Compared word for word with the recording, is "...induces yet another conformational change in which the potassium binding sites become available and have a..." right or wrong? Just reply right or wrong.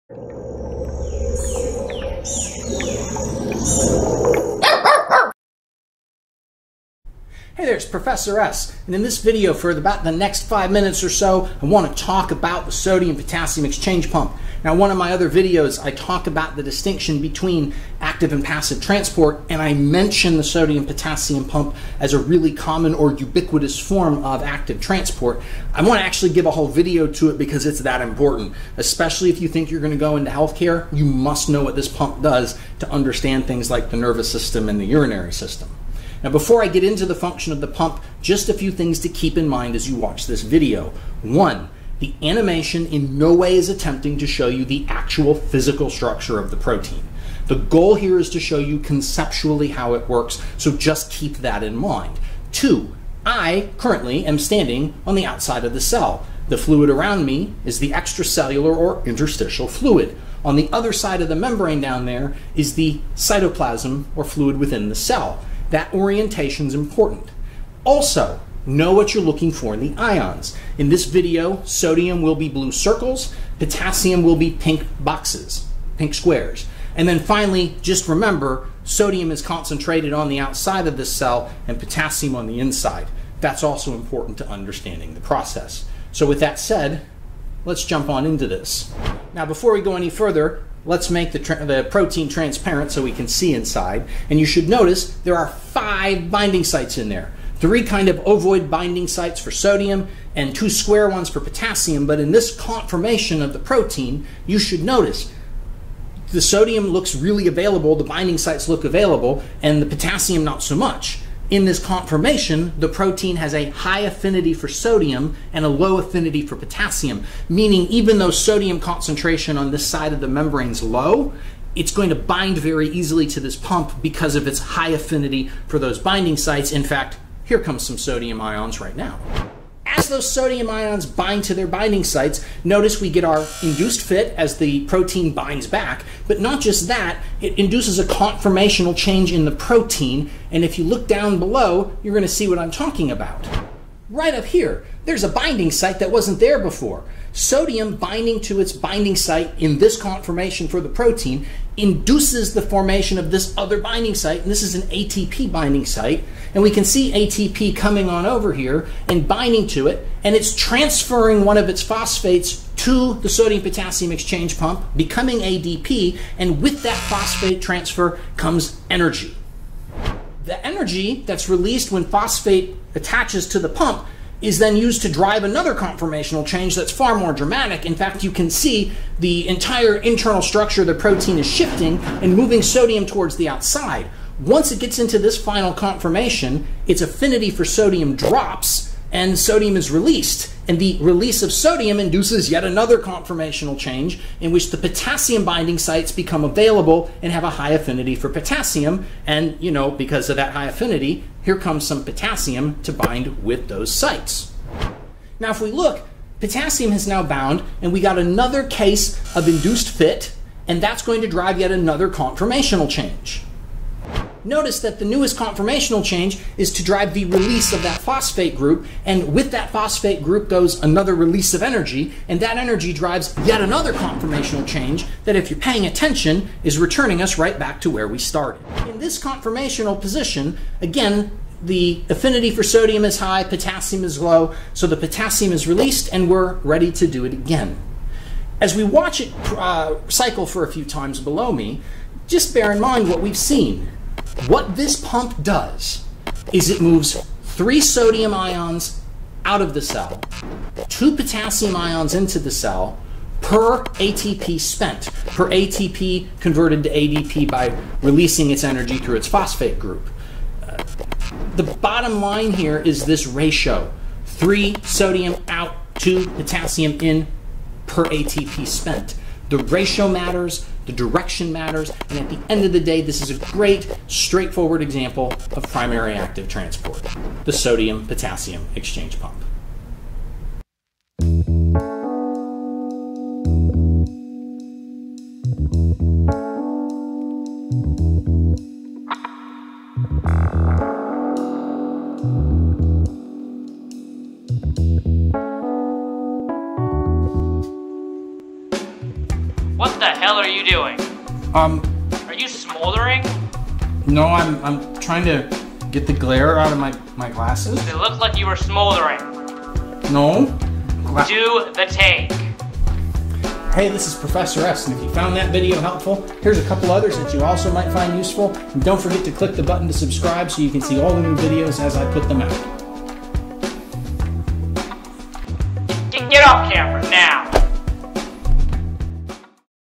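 right.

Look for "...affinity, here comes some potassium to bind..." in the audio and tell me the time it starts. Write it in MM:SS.
03:20.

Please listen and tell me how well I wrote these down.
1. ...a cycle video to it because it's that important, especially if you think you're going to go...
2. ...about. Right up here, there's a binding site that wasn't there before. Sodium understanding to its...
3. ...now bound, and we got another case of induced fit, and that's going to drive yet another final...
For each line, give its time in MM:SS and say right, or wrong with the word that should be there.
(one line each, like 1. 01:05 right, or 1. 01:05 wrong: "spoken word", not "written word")
1. 00:26 wrong: "whole", not "cycle"
2. 02:23 wrong: "binding", not "understanding"
3. 03:27 wrong: "conformational", not "final".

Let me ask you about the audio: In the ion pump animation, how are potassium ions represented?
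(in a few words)
pink squares.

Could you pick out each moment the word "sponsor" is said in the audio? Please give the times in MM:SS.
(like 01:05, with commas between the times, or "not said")
not said.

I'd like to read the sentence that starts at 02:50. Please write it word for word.
The energy that's released when phosphate attaches to the pump is then used to drive another conformational change that's far more dramatic.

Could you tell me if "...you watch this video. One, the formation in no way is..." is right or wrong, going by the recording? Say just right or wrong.
wrong.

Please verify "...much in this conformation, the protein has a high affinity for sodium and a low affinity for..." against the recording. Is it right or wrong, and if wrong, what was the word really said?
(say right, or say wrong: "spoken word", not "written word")
right.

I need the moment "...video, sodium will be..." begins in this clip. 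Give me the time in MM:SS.
01:11.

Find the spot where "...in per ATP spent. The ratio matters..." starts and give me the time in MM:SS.
04:27.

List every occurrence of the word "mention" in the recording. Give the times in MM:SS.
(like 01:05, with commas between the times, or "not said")
00:19.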